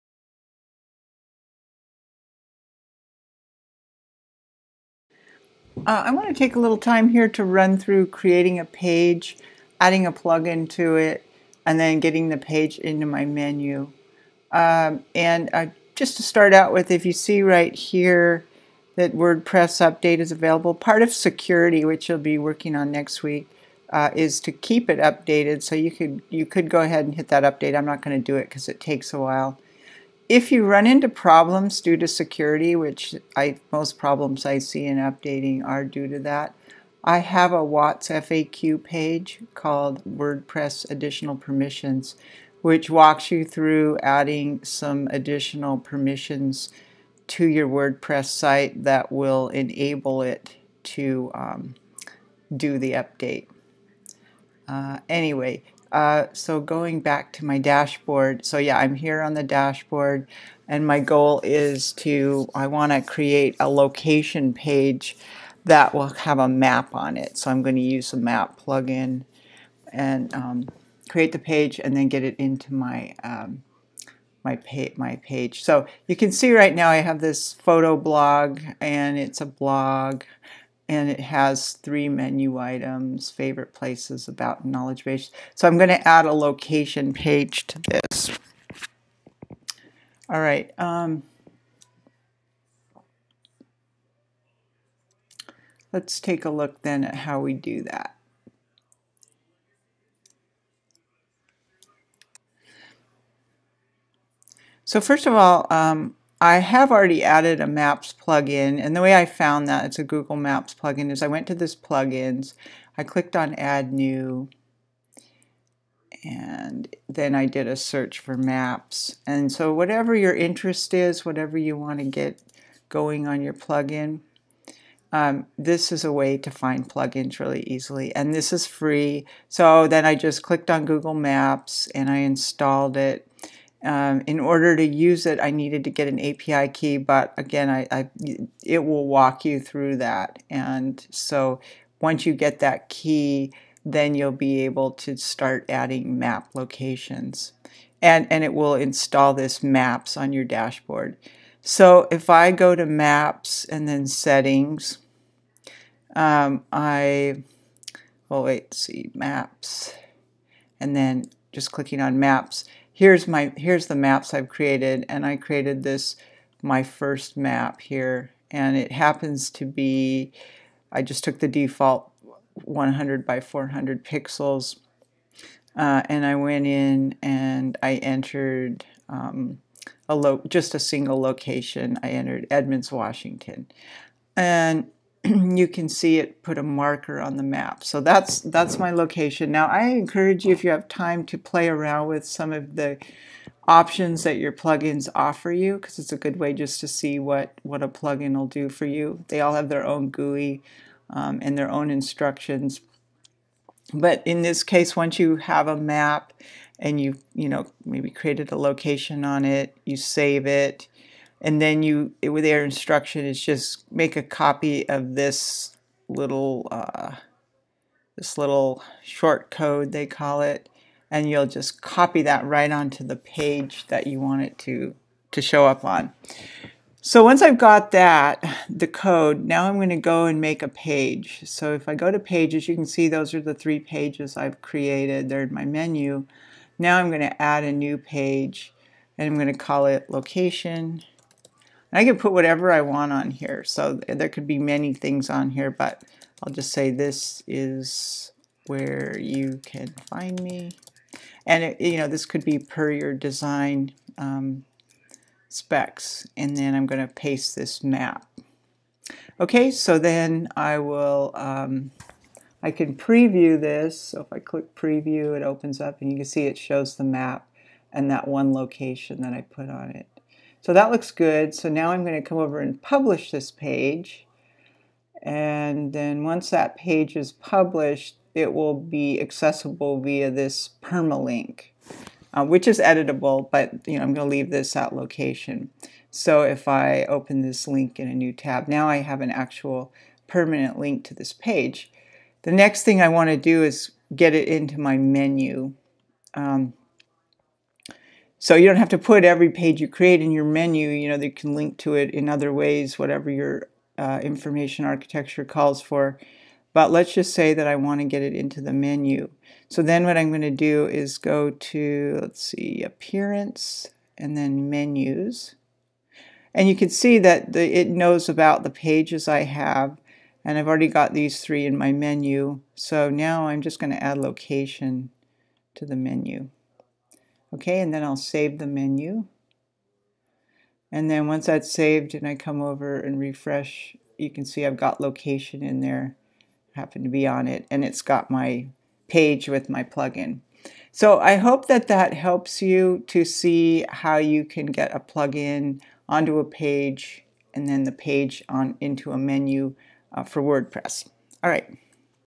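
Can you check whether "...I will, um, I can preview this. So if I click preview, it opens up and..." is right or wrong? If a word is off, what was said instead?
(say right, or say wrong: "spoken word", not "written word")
right.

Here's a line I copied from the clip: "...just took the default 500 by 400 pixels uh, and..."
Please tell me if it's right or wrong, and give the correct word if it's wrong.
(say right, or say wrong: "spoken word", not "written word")
wrong: "100", not "500".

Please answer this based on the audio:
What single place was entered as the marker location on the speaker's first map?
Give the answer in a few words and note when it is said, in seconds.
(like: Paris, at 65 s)
Edmonds, Washington, at 182 s.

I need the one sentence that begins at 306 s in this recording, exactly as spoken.
But let's just say that I want to get it into the menu.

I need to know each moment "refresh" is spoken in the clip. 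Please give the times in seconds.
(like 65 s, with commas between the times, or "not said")
333 s.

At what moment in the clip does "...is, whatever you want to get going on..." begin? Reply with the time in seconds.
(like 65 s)
120 s.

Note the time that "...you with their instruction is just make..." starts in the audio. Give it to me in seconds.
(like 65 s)
211 s.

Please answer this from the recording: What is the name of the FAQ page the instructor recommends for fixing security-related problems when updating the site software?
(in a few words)
WordPress Additional Permissions.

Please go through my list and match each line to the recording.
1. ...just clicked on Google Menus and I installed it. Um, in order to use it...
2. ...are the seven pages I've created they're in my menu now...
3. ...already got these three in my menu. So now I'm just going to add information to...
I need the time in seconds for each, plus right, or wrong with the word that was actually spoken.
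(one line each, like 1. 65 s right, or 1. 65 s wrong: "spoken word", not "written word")
1. 130 s wrong: "Maps", not "Menus"
2. 233 s wrong: "three", not "seven"
3. 320 s wrong: "location", not "information".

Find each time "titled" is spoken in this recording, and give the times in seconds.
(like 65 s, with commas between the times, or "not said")
not said.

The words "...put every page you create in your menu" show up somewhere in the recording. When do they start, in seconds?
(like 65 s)
298 s.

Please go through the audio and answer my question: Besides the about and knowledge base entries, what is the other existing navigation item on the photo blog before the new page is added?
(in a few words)
favorite places.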